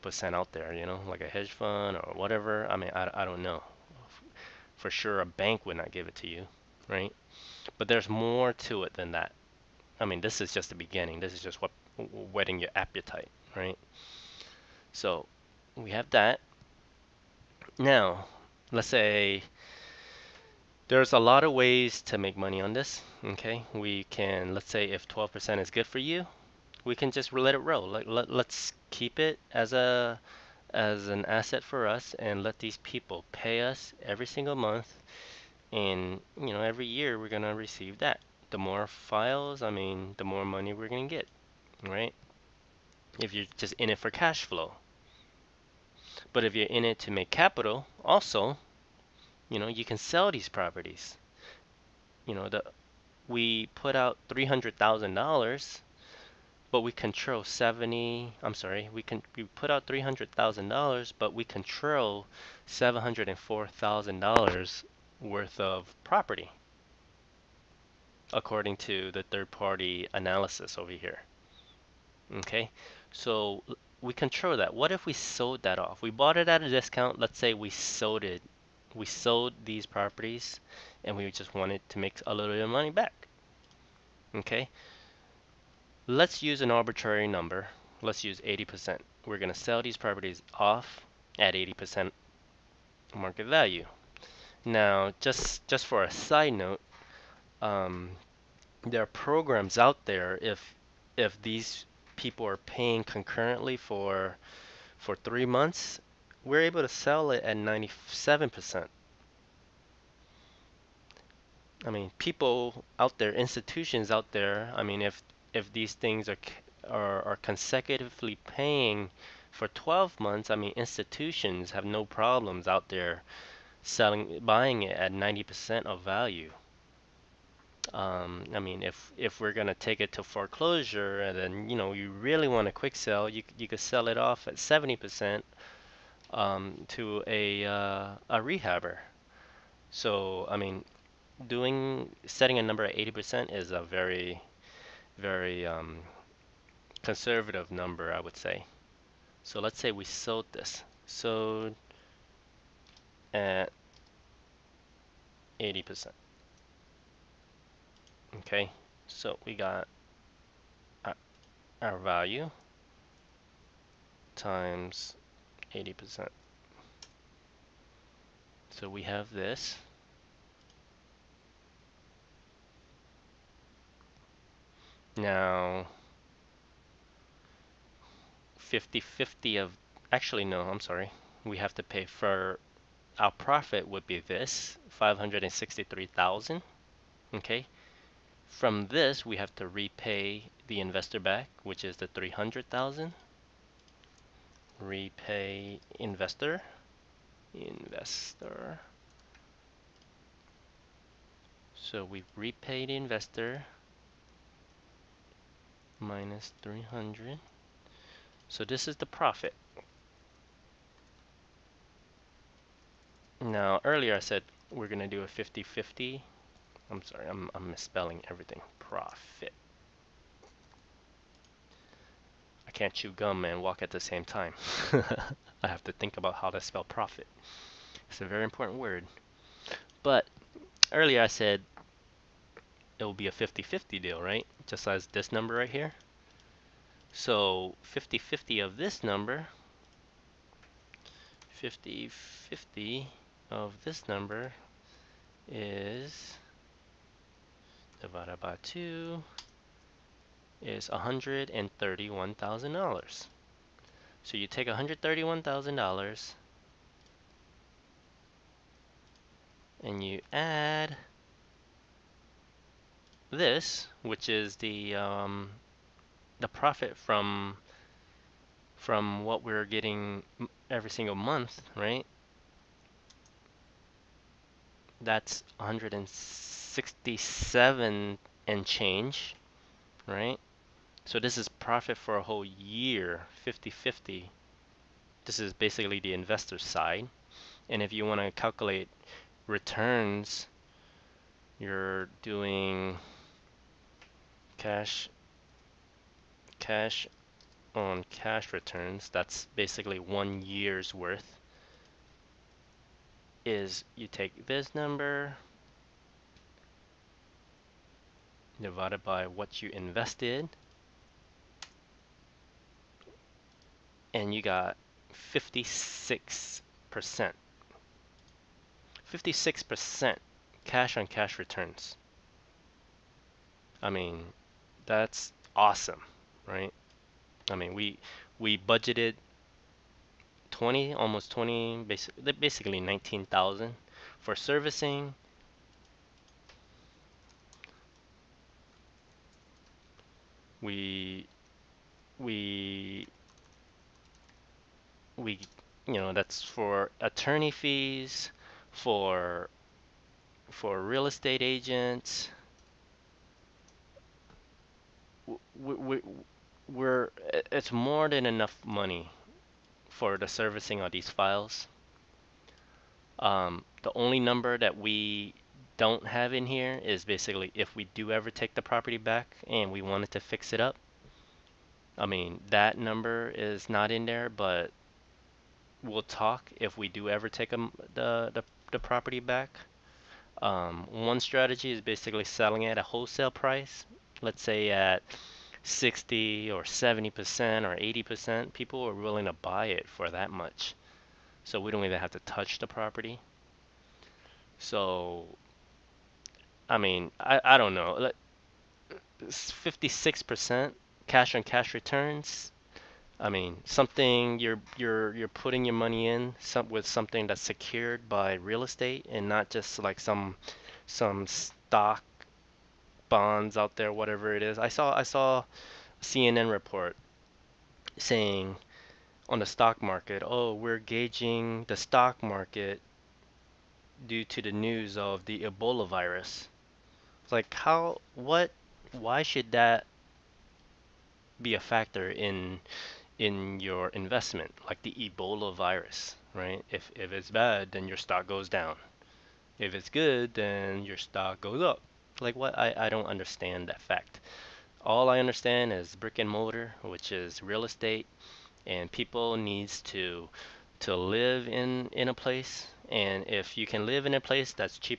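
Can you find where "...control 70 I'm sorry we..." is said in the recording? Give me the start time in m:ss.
0:56.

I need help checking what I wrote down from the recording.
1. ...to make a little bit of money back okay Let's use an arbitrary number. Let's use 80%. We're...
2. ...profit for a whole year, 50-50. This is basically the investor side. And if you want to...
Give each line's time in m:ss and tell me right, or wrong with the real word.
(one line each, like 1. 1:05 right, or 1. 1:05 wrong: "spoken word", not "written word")
1. 1:21 right
2. 4:41 right.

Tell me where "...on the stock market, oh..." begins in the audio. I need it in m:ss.
6:59.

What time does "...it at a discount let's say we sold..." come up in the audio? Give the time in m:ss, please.
1:16.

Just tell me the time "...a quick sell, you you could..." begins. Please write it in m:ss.
2:12.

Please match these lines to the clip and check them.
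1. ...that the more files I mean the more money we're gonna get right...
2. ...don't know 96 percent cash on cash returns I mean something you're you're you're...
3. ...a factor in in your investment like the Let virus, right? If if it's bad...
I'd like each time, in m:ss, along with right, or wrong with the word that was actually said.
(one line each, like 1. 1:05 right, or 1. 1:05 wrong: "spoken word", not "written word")
1. 0:37 right
2. 6:37 wrong: "56", not "96"
3. 7:11 wrong: "Ebola", not "Let".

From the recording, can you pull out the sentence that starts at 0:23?
Okay, we can let's say if 12% is good for you, we can just let it roll.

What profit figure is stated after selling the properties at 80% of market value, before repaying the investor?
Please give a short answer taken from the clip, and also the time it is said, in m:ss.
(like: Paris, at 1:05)
563,000, at 3:04.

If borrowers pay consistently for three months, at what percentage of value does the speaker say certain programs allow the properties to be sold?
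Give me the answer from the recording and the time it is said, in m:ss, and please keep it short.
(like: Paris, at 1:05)
97%, at 1:47.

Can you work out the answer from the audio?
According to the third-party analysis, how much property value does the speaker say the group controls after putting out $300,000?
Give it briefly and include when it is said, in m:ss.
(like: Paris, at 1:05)
$704,000, at 1:02.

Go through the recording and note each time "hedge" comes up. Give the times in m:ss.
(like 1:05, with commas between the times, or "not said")
0:01.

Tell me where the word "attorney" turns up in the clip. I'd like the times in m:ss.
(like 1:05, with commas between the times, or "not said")
5:47.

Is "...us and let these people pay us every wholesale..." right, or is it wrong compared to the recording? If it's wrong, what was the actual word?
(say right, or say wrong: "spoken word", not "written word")
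wrong: "single", not "wholesale".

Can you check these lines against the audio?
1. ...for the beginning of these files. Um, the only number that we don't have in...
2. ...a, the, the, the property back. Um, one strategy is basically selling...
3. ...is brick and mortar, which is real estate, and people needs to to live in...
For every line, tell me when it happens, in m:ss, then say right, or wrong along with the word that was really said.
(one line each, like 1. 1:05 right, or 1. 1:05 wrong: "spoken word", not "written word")
1. 5:59 wrong: "servicing", not "beginning"
2. 6:17 right
3. 7:25 right.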